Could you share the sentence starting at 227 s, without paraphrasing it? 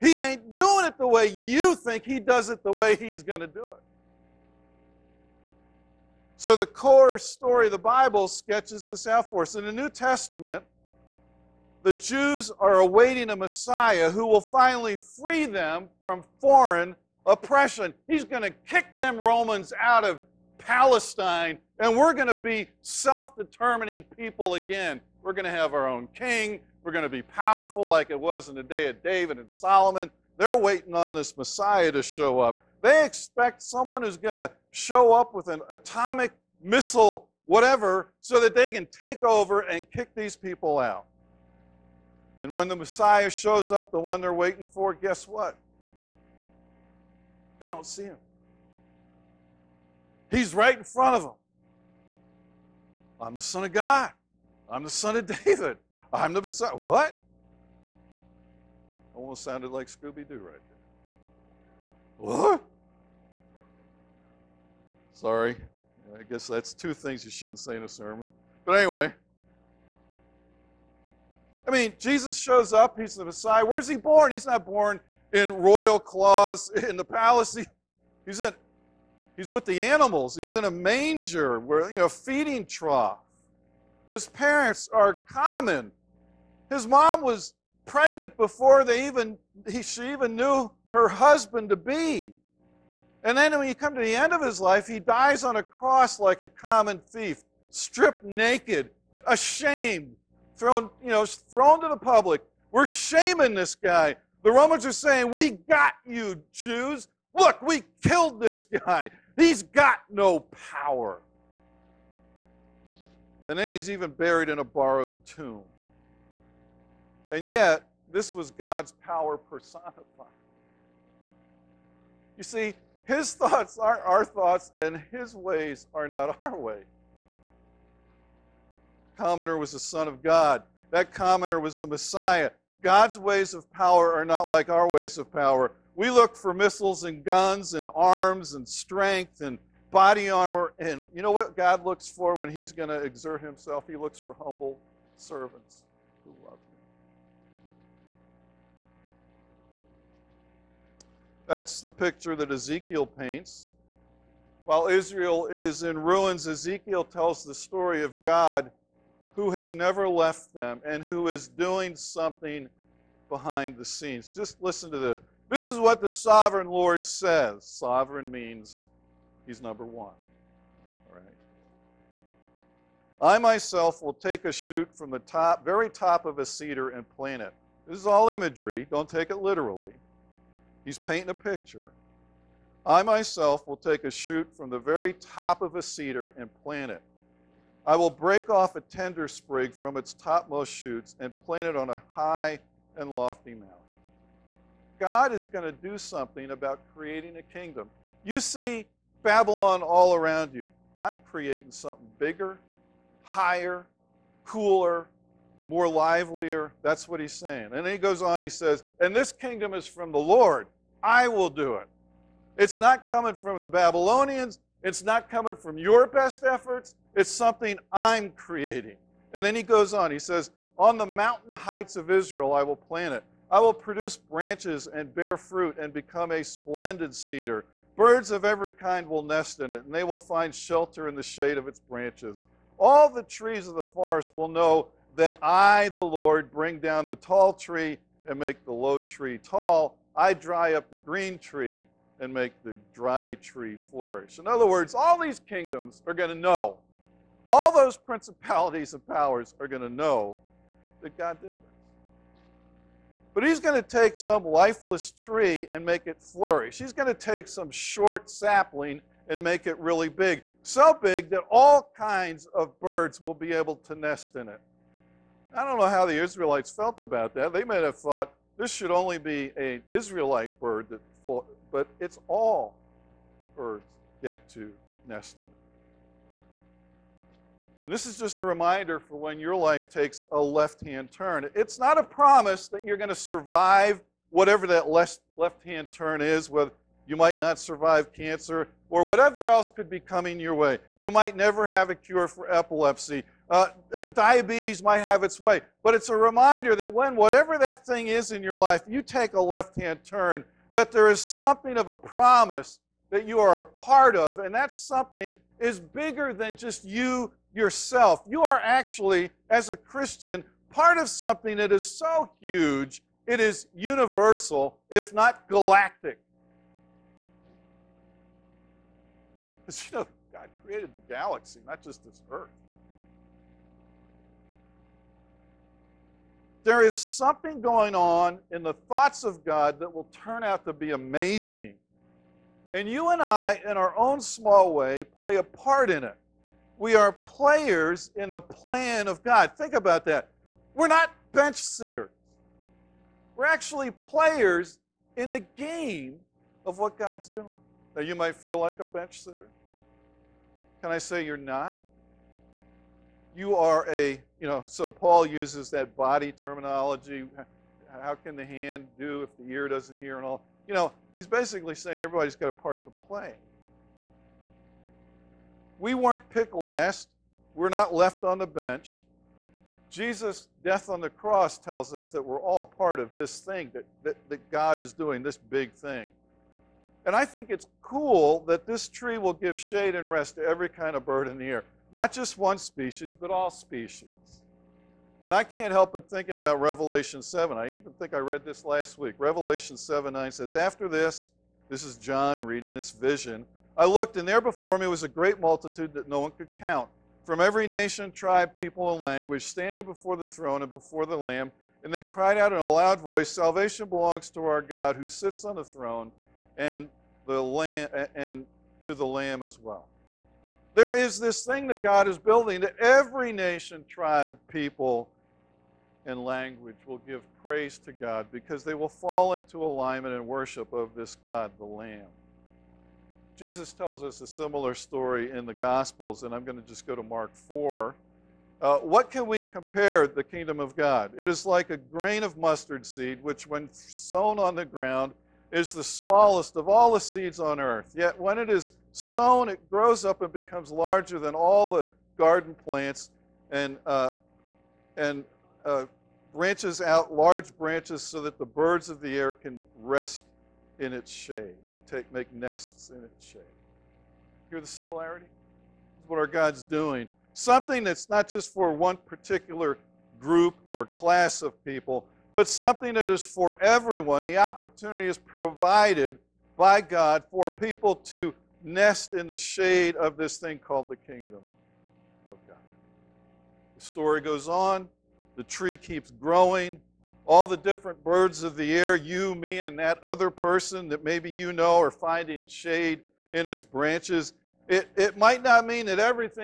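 Birds of every kind will nest in it, and they will find shelter in the shade of its branches.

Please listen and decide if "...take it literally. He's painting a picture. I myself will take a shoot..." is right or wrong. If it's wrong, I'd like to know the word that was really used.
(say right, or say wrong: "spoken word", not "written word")
right.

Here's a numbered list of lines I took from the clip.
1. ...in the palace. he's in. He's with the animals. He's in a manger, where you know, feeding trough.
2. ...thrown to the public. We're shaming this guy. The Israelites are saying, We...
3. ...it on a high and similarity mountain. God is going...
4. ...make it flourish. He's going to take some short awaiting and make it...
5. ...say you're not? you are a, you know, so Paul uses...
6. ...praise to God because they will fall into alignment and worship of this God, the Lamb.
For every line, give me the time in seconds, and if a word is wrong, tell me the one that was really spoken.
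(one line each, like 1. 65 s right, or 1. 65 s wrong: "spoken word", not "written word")
1. 76 s right
2. 101 s wrong: "Romans", not "Israelites"
3. 191 s wrong: "lofty", not "similarity"
4. 255 s wrong: "sapling", not "awaiting"
5. 350 s right
6. 417 s right.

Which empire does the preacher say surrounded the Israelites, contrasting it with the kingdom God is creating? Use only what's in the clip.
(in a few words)
Babylon.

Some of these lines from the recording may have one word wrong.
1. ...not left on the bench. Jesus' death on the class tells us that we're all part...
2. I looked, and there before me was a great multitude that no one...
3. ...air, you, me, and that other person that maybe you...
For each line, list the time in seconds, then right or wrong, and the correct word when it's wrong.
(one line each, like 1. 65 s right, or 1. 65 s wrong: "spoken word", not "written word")
1. 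367 s wrong: "cross", not "class"
2. 393 s right
3. 478 s right.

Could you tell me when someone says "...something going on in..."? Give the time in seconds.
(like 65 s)
326 s.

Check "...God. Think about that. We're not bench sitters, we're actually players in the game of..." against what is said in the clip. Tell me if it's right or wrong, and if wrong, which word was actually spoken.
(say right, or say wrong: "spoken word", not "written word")
right.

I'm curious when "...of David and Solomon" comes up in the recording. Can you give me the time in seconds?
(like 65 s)
28 s.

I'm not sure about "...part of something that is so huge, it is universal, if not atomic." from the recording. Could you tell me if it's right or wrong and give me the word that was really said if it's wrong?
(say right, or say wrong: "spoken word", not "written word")
wrong: "galactic", not "atomic".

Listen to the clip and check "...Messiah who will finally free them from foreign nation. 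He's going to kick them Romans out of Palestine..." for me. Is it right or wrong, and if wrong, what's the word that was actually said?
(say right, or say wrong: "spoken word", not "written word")
wrong: "oppression", not "nation".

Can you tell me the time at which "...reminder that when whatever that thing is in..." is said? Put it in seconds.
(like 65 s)
296 s.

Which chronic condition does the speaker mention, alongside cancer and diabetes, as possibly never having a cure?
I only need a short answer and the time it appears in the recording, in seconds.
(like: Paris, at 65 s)
Epilepsy, at 292 s.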